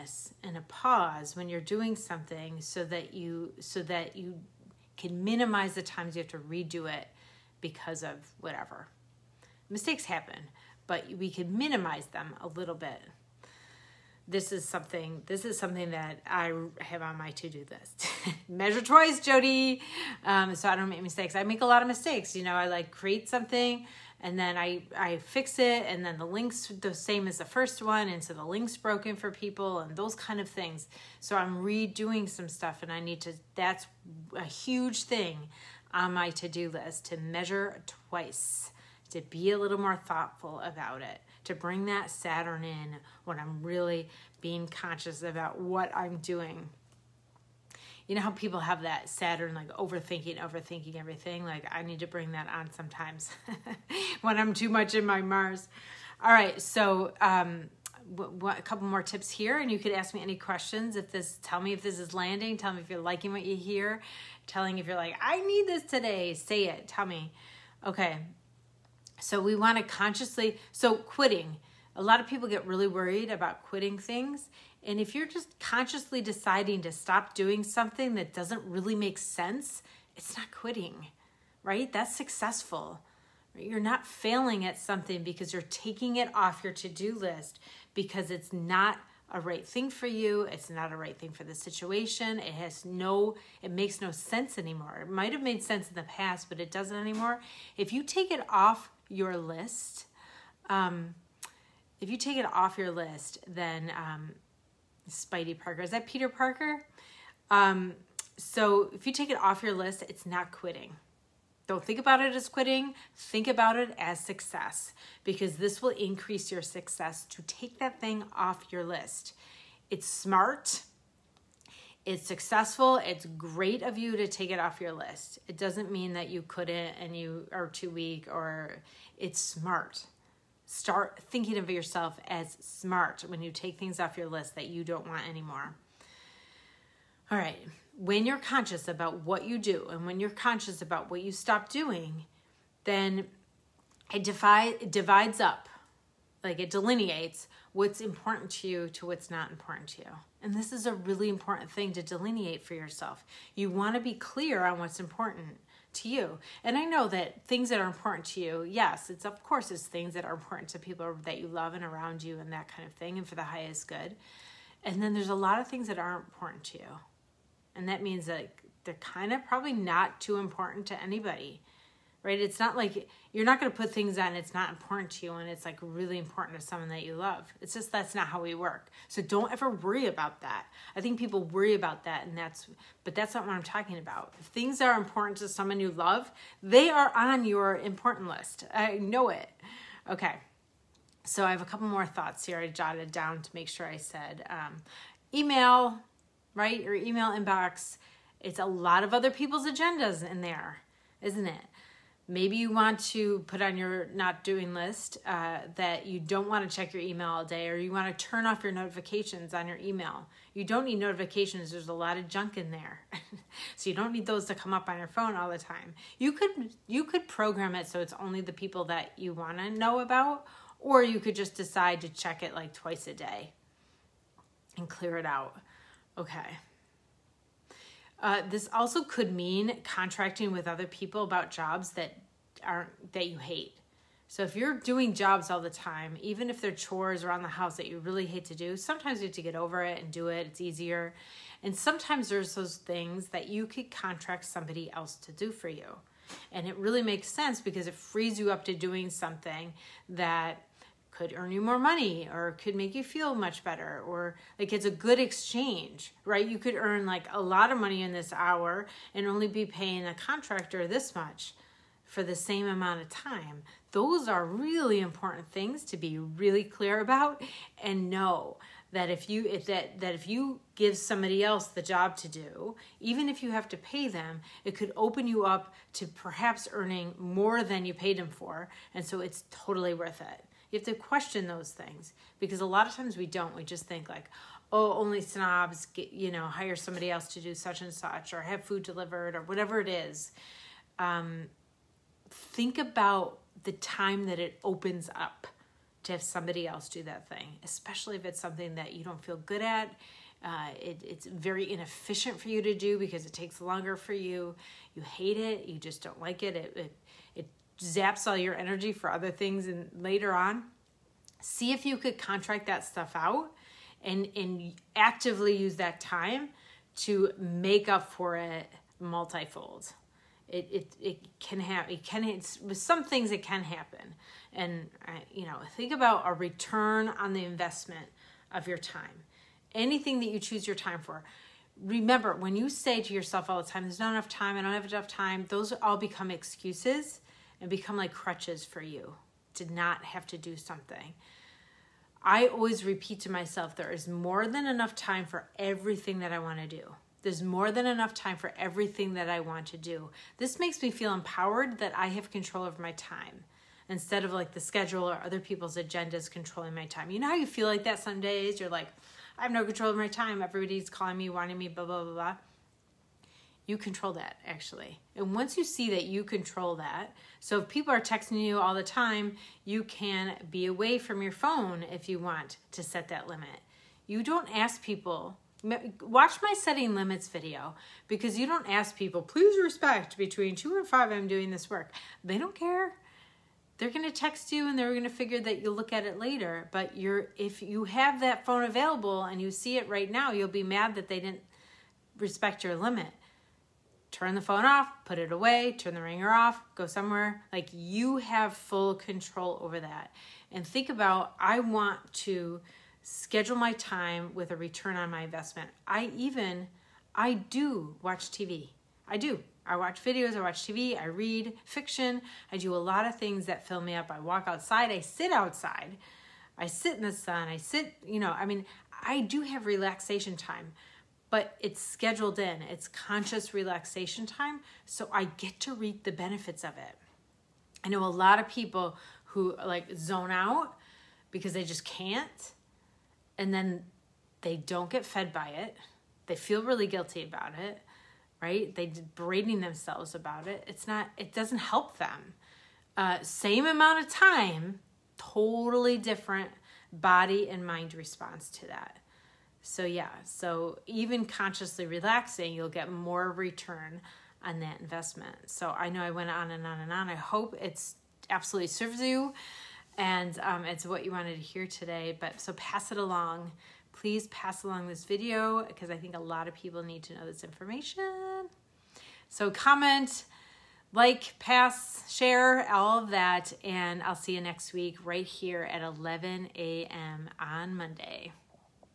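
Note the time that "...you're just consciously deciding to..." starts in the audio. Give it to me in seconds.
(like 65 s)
75 s.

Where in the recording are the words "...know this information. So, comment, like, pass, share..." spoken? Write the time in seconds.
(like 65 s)
467 s.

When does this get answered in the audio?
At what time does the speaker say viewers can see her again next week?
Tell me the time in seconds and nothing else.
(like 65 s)
475 s.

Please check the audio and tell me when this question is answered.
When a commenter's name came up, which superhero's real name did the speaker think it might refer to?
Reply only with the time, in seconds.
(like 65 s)
106 s.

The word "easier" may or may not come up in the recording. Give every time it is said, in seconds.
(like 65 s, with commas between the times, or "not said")
240 s.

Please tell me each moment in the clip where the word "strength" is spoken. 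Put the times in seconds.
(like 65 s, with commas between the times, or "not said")
not said.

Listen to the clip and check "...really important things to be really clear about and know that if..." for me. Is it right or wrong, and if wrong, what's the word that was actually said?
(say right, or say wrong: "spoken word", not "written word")
right.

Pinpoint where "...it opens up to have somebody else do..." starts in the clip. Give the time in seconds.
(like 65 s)
294 s.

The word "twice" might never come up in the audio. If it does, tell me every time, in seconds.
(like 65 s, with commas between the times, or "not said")
18 s, 38 s, 222 s.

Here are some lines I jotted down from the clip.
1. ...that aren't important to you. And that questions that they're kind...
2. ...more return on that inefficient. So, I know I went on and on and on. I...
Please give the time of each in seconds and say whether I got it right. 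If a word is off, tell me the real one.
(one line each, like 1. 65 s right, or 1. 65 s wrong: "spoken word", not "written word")
1. 165 s wrong: "means", not "questions"
2. 452 s wrong: "investment", not "inefficient".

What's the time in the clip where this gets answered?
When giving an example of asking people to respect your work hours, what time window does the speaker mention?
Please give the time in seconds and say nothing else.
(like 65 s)
380 s.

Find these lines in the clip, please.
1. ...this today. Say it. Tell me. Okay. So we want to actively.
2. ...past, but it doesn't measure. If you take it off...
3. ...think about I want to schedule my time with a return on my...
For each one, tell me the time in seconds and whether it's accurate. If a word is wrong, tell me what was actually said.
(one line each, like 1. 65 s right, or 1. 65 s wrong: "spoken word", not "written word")
1. 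65 s wrong: "consciously", not "actively"
2. 96 s wrong: "anymore", not "measure"
3. 400 s right.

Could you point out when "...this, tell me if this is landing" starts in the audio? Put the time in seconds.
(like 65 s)
61 s.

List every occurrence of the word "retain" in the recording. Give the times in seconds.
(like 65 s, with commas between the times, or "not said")
not said.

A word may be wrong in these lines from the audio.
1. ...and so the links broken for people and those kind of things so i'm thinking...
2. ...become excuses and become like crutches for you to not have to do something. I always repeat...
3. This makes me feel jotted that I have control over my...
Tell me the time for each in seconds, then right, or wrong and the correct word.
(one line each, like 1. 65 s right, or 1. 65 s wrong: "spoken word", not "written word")
1. 28 s wrong: "redoing", not "thinking"
2. 335 s right
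3. 350 s wrong: "empowered", not "jotted".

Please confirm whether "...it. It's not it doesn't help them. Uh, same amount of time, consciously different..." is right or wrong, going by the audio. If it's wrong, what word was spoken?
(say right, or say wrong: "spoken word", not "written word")
wrong: "totally", not "consciously".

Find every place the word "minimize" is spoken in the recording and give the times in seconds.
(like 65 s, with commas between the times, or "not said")
5 s, 11 s.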